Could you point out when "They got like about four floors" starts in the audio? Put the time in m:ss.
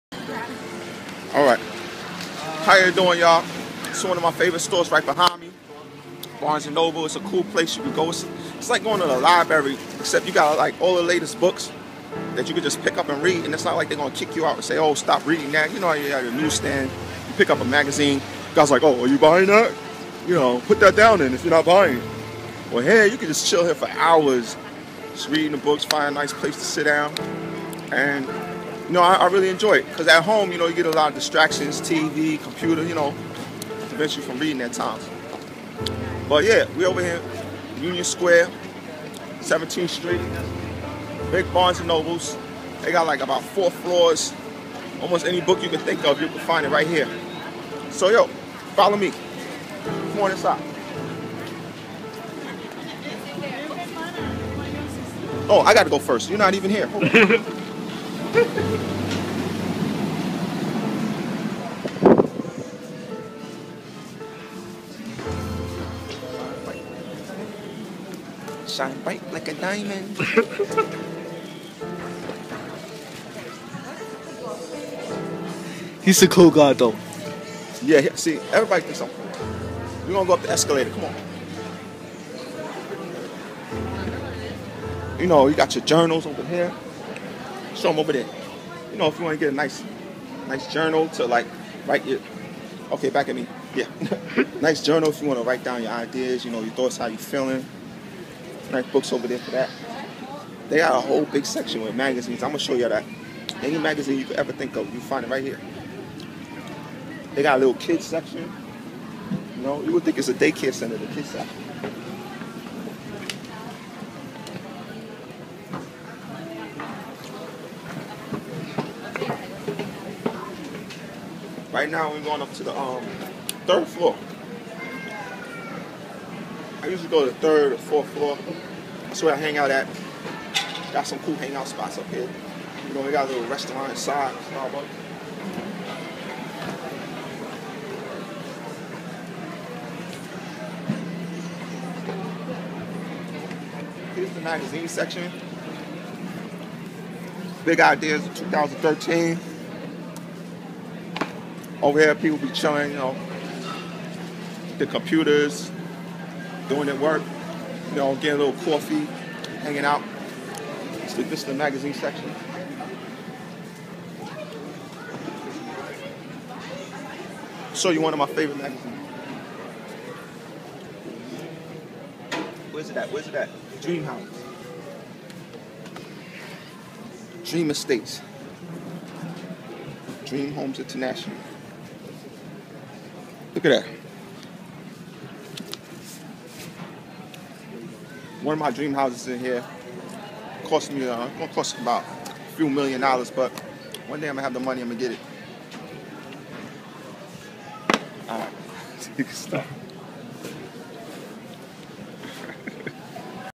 0:42.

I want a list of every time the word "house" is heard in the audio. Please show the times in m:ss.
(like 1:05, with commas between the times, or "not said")
2:54, 3:08.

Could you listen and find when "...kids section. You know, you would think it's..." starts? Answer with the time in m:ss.
1:47.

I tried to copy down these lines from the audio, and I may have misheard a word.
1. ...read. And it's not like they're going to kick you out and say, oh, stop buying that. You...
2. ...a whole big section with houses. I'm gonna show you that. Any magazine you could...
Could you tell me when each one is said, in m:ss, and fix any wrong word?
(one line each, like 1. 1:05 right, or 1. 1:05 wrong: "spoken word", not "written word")
1. 0:13 wrong: "reading", not "buying"
2. 1:40 wrong: "magazines", not "houses".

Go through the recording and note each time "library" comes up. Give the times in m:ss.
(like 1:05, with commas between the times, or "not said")
0:09.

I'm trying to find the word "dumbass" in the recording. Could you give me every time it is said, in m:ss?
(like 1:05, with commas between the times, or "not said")
not said.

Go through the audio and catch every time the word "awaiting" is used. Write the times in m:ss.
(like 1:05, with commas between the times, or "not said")
not said.